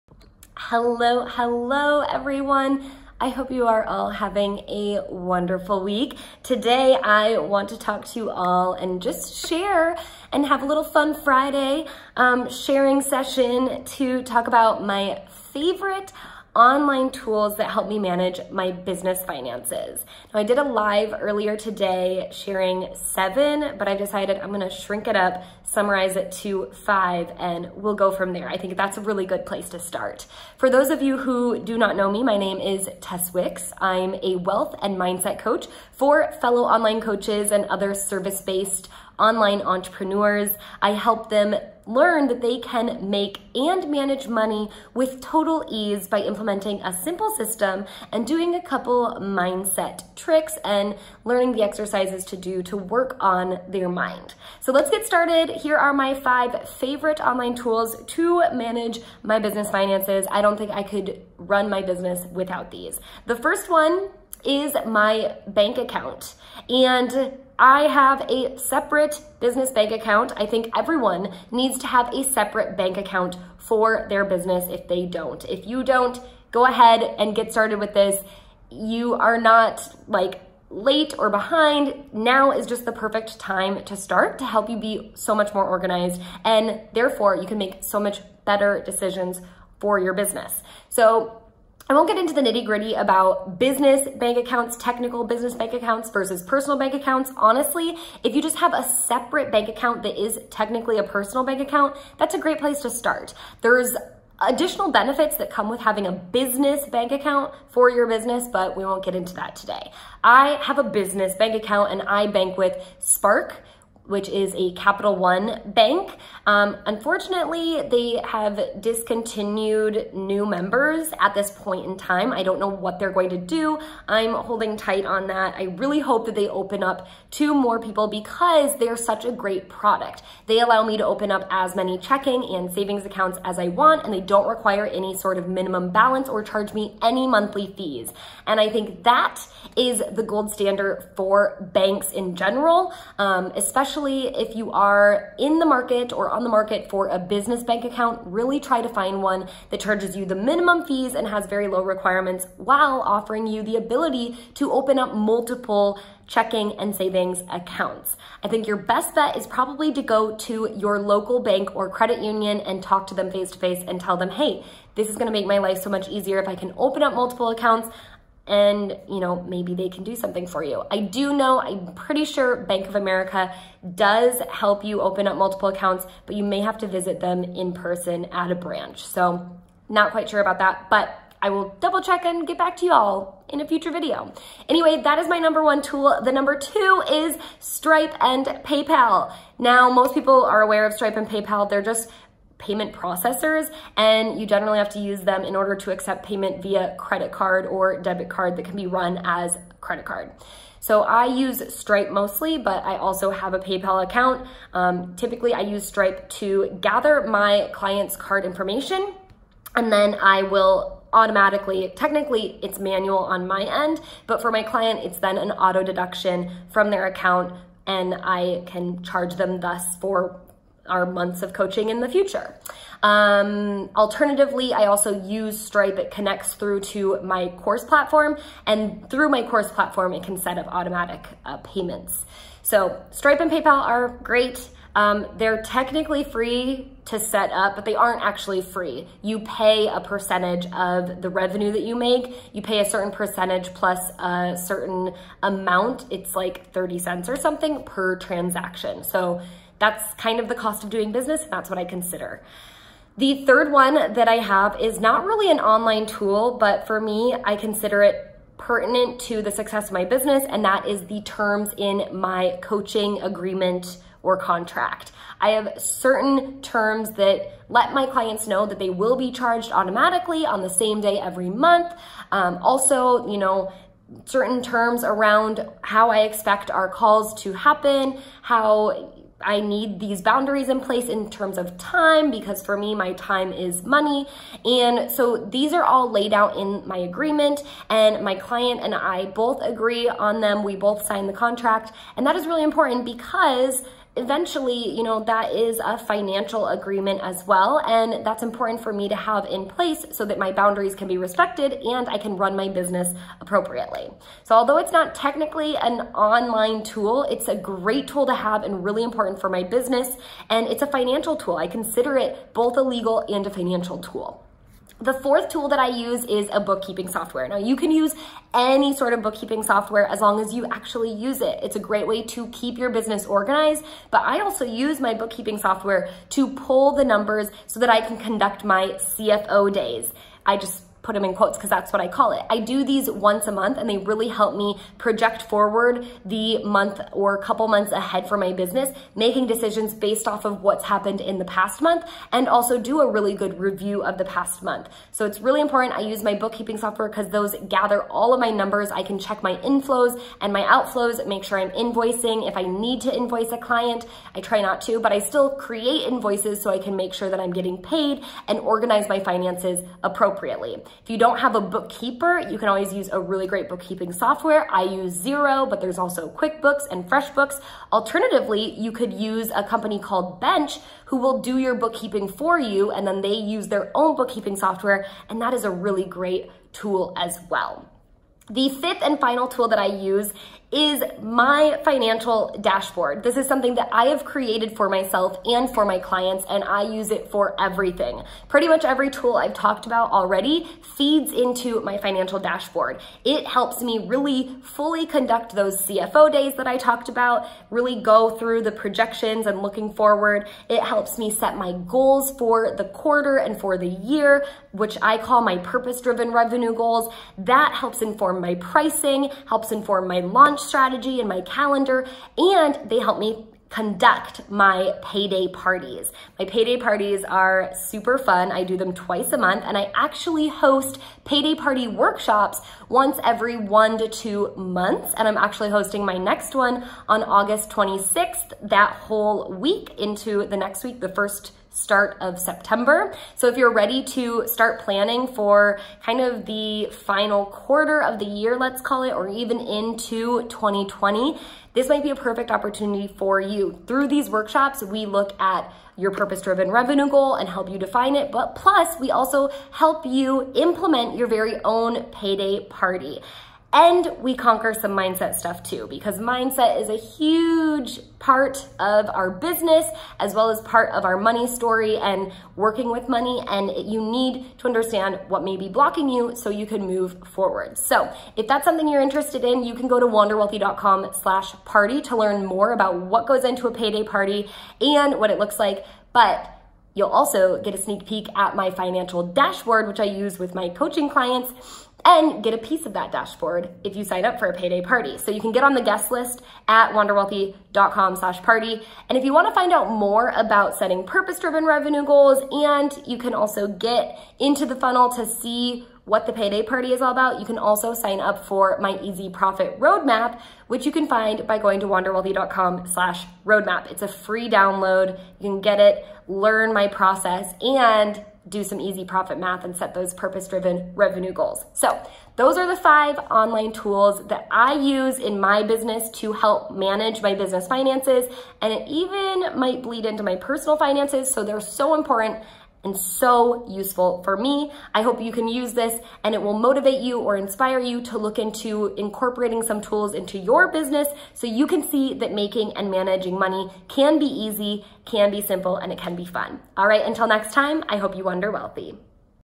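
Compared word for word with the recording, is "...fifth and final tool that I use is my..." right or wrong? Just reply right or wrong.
right.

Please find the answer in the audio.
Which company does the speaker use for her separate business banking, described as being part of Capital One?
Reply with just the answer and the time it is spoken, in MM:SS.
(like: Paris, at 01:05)
Spark, at 01:52.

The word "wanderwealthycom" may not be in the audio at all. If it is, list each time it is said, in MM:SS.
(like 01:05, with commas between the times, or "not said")
07:50, 08:06, 08:21.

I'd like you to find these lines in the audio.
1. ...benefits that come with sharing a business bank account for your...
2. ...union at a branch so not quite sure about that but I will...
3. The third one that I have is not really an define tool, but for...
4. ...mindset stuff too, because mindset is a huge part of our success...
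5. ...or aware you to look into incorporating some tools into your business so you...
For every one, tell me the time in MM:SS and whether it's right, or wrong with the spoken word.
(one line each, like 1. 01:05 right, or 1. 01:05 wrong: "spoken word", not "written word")
1. 01:44 wrong: "having", not "sharing"
2. 02:57 wrong: "person", not "union"
3. 04:13 wrong: "online", not "define"
4. 07:34 wrong: "business", not "success"
5. 08:47 wrong: "inspire", not "aware".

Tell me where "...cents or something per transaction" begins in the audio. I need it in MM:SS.
04:06.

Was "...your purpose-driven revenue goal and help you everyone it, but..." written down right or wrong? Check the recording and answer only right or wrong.
wrong.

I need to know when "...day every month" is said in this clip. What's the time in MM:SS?
04:31.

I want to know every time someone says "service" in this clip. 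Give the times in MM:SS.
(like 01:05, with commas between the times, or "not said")
00:37.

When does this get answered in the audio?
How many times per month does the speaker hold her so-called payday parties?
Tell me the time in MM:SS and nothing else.
06:58.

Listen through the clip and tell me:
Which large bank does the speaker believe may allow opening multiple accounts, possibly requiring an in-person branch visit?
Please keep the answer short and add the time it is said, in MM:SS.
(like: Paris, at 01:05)
Bank of America, at 02:52.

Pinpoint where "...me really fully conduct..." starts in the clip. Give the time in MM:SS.
06:33.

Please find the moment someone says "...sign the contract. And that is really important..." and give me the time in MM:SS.
04:51.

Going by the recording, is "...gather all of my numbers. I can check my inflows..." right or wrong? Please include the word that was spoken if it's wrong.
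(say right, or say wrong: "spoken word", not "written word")
right.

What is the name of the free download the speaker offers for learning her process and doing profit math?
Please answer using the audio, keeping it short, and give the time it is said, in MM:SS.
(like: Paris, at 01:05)
easy profit roadmap, at 08:19.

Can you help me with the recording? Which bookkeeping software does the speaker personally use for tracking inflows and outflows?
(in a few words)
Xero.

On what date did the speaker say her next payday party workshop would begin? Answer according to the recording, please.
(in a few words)
August 26th.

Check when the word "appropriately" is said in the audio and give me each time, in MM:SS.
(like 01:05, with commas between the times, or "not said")
05:03, 06:00.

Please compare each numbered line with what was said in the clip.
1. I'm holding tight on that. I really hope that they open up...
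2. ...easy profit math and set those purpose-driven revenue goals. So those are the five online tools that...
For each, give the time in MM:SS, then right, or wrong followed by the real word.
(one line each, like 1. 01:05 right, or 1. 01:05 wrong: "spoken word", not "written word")
1. 02:04 right
2. 08:28 right.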